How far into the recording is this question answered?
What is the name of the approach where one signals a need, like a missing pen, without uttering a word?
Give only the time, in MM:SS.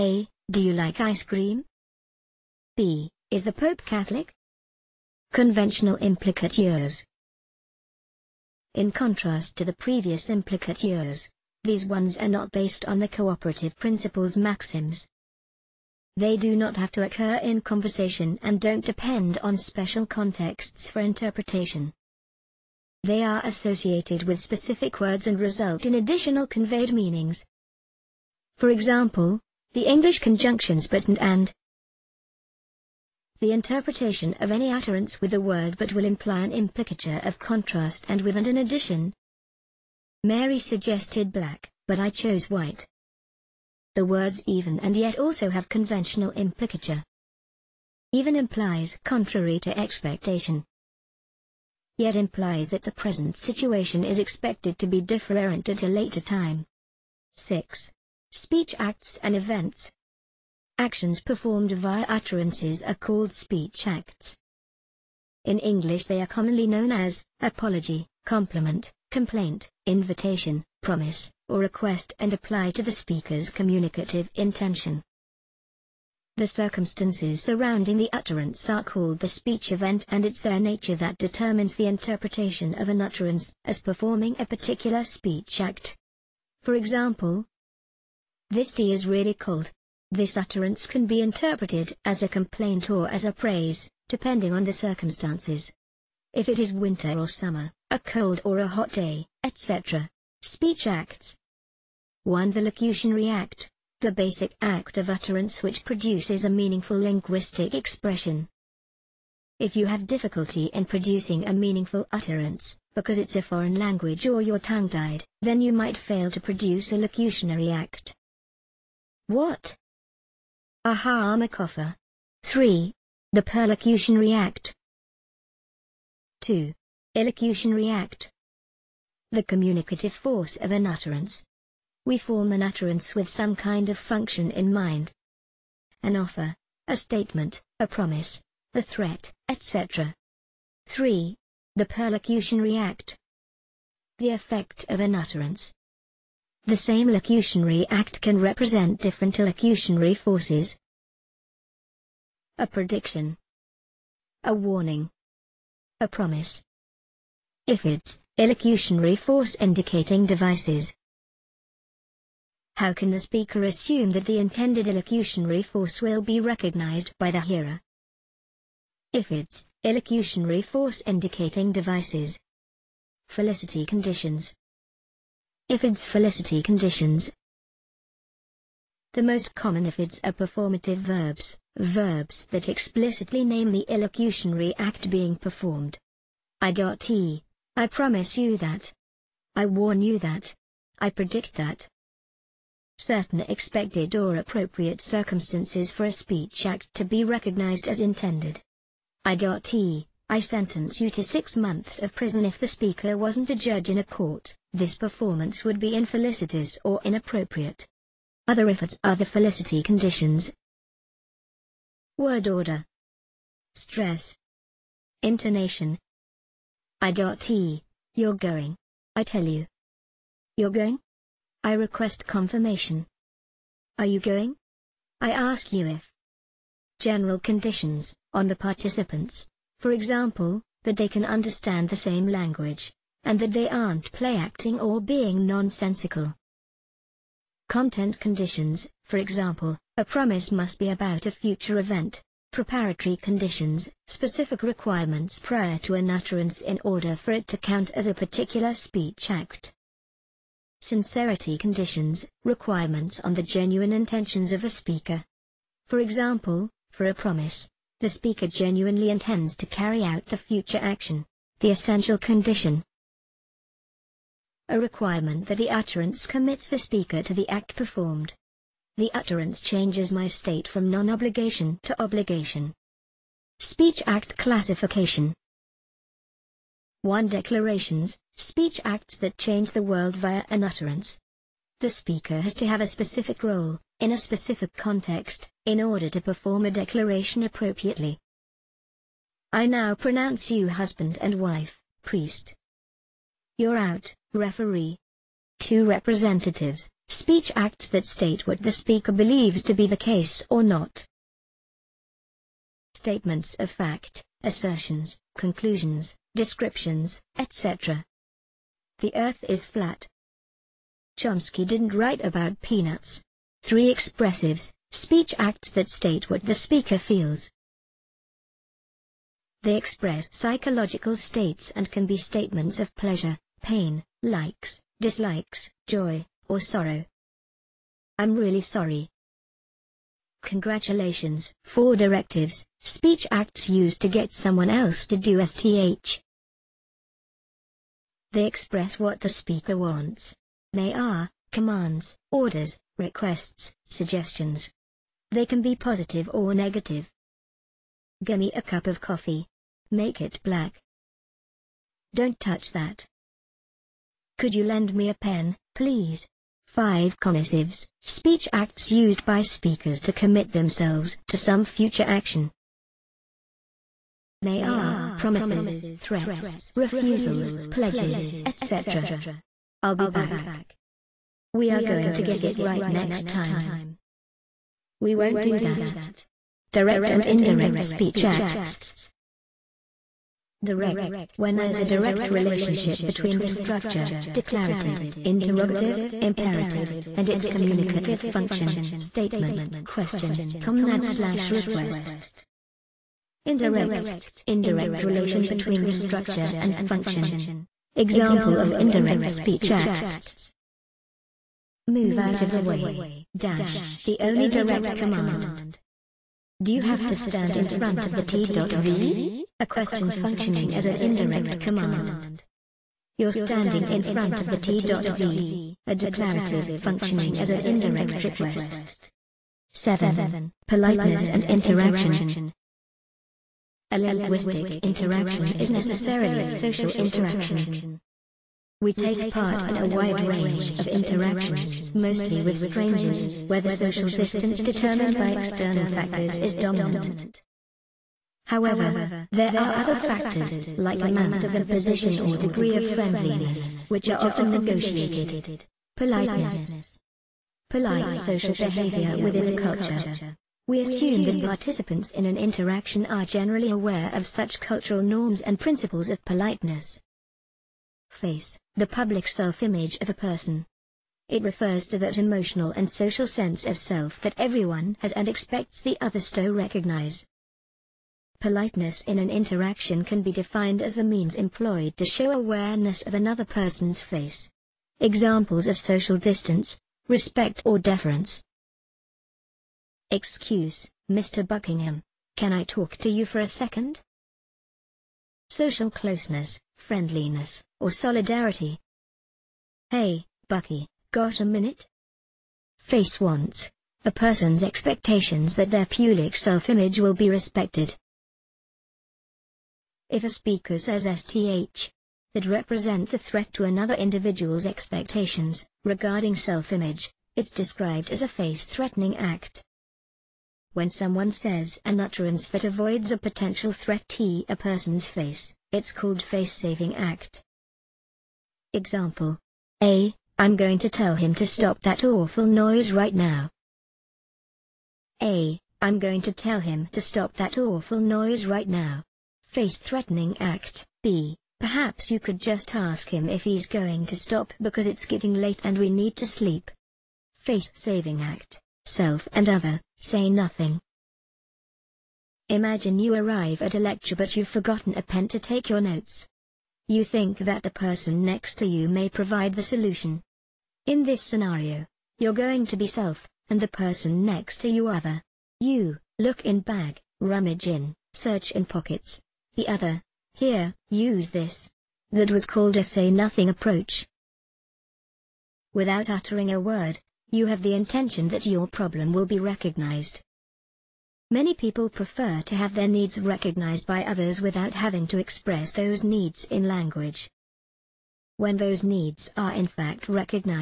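09:22.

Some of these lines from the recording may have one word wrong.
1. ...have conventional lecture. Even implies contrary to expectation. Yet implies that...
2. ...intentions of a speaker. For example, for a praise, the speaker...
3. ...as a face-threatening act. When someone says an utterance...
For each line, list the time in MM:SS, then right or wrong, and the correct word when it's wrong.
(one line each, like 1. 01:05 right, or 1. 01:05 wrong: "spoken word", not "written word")
1. 00:45 wrong: "implicature", not "lecture"
2. 04:13 wrong: "promise", not "praise"
3. 08:28 right.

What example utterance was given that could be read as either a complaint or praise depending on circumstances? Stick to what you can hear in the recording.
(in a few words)
this tea is really cold.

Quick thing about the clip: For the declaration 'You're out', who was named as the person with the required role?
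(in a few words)
referee.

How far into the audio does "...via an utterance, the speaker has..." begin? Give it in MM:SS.
04:40.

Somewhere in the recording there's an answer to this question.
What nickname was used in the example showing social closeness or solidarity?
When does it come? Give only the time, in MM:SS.
08:10.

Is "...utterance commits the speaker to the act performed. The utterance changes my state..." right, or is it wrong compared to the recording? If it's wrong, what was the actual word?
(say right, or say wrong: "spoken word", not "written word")
right.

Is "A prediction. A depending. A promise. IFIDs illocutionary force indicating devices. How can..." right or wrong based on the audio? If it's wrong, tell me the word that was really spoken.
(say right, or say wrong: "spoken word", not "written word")
wrong: "warning", not "depending".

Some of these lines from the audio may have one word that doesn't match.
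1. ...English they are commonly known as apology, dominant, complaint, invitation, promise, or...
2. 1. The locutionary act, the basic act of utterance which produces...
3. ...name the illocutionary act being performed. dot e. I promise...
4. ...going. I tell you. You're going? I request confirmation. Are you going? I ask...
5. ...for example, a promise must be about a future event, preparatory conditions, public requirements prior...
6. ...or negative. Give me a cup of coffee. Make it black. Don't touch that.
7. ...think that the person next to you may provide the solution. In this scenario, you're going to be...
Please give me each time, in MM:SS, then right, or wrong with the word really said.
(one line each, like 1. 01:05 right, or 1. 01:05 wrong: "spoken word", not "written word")
1. 01:05 wrong: "compliment", not "dominant"
2. 01:42 right
3. 03:03 right
4. 03:38 right
5. 03:59 wrong: "specific", not "public"
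6. 05:46 right
7. 09:07 right.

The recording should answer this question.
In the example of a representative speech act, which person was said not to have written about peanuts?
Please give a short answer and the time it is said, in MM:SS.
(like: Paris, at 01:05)
Chomsky, at 05:11.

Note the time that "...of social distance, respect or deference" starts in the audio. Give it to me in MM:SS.
07:55.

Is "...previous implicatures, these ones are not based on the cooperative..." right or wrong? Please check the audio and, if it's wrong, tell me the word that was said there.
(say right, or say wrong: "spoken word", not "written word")
right.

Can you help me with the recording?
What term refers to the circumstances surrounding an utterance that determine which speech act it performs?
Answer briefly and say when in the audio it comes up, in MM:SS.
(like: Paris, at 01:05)
speech event, at 01:19.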